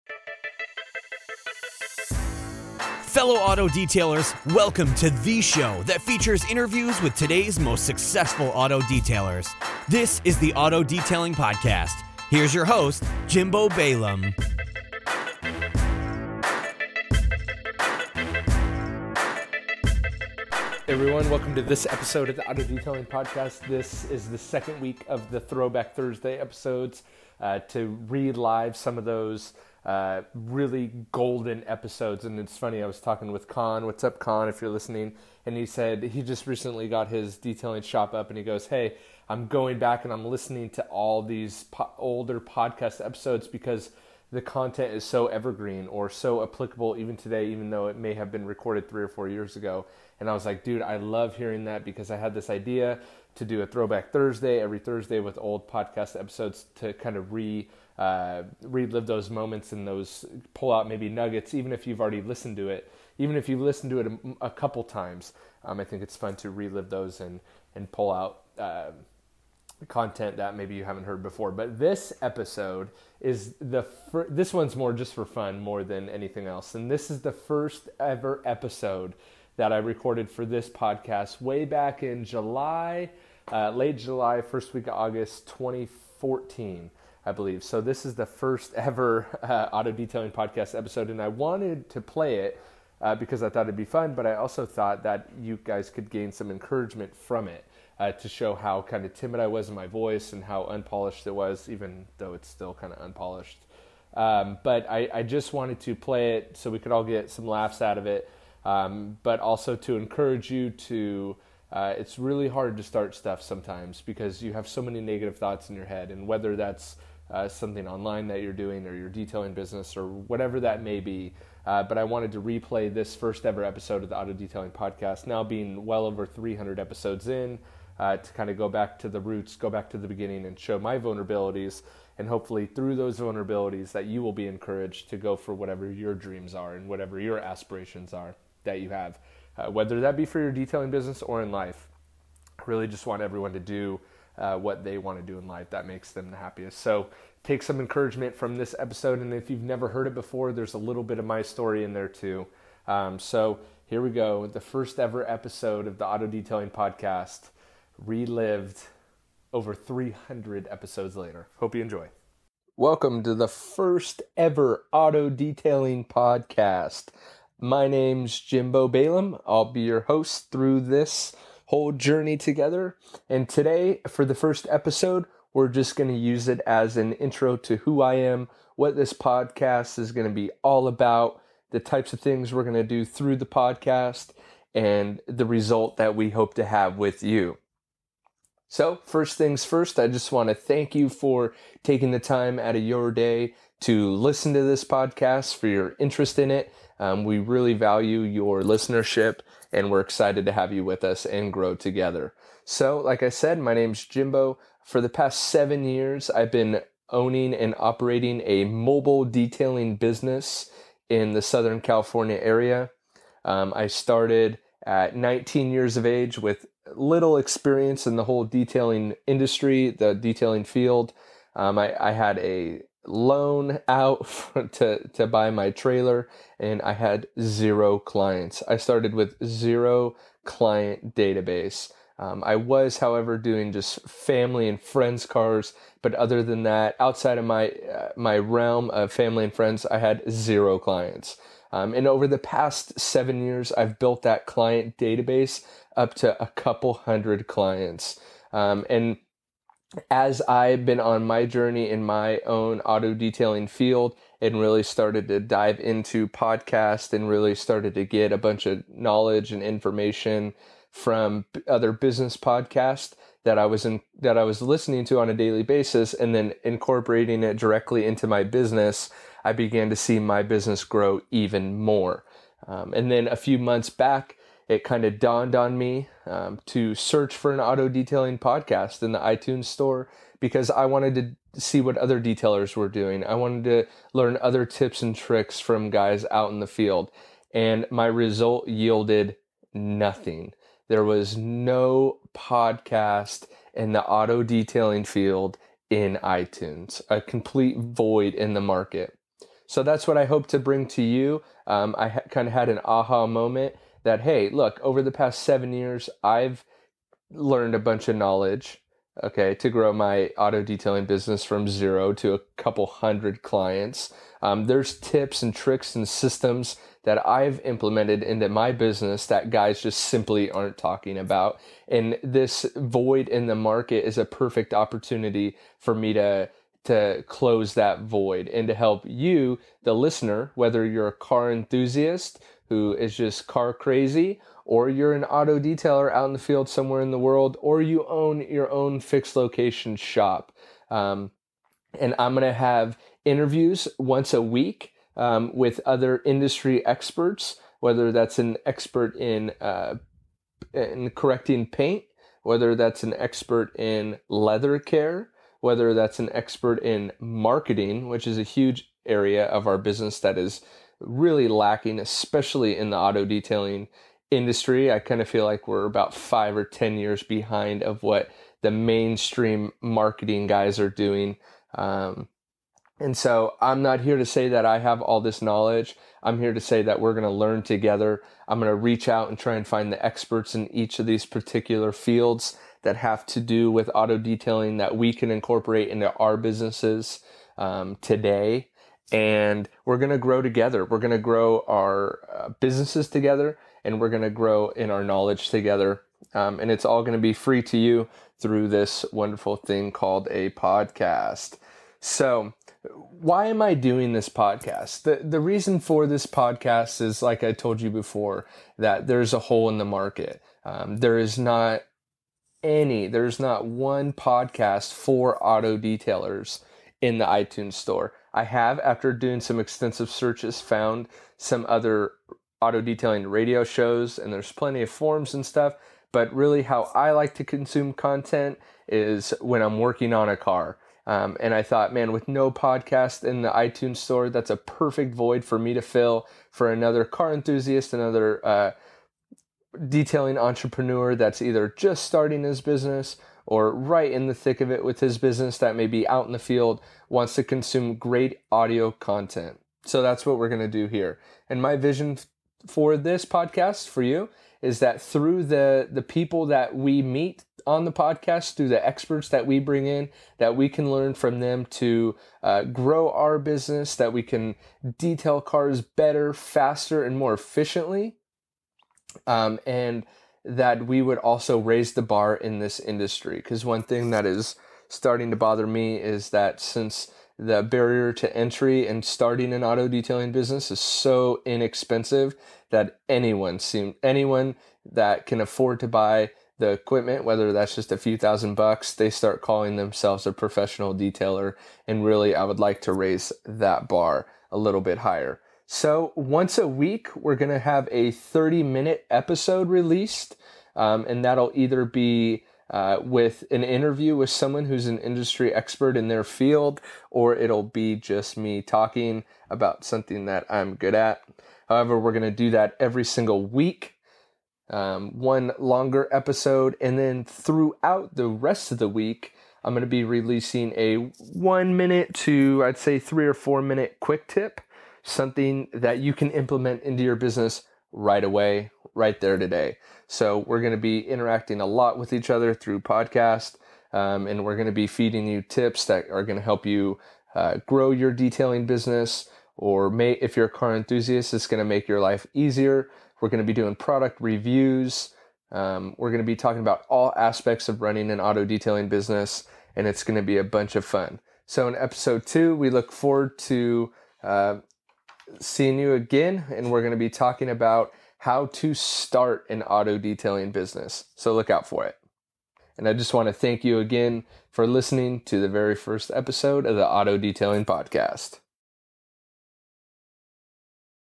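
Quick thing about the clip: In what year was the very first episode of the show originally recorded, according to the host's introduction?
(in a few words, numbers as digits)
2014.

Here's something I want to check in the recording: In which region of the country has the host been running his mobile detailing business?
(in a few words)
Southern California.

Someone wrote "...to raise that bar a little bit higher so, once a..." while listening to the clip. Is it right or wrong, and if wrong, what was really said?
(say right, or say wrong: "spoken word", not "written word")
right.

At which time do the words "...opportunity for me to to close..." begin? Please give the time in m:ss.
5:24.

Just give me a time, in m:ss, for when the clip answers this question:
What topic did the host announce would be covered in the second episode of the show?
9:18.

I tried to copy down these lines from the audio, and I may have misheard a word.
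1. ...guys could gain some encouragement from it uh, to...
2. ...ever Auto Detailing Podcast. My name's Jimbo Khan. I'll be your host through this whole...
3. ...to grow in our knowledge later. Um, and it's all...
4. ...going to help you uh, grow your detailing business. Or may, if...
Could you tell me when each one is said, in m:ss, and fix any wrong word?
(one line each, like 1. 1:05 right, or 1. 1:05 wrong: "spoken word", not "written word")
1. 1:35 right
2. 2:44 wrong: "Balaam", not "Khan"
3. 6:34 wrong: "together", not "later"
4. 8:56 right.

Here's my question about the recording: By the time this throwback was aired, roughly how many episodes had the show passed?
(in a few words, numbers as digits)
over 300.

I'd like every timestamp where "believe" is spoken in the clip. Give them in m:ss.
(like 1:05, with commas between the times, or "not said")
1:27.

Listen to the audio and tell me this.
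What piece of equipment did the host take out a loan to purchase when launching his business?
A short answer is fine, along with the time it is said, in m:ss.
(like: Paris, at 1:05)
trailer, at 3:45.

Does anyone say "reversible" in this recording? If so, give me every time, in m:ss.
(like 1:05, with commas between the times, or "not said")
not said.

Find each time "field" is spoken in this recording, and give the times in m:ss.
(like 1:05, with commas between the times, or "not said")
3:40, 4:13, 4:46, 4:55, 5:36, 6:21, 7:26, 8:26.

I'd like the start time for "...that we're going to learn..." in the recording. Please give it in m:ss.
6:16.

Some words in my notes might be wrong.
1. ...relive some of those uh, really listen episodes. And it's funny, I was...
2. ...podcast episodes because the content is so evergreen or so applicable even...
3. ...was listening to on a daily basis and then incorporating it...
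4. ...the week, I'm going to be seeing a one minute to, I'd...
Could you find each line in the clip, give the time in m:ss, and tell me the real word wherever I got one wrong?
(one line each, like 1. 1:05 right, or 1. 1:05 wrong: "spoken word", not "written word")
1. 0:28 wrong: "golden", not "listen"
2. 0:42 right
3. 4:24 right
4. 8:38 wrong: "releasing", not "seeing".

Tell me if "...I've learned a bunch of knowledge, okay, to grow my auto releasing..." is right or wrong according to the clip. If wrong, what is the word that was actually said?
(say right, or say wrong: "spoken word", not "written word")
wrong: "detailing", not "releasing".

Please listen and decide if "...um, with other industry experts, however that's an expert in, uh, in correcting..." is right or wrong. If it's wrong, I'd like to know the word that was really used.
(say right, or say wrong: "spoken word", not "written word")
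wrong: "whether", not "however".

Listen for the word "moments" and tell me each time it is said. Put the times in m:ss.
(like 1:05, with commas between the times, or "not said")
0:59, 5:03.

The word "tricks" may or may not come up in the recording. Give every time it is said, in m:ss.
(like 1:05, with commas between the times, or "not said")
4:45, 5:15.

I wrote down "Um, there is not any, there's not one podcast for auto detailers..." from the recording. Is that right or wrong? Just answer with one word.
right.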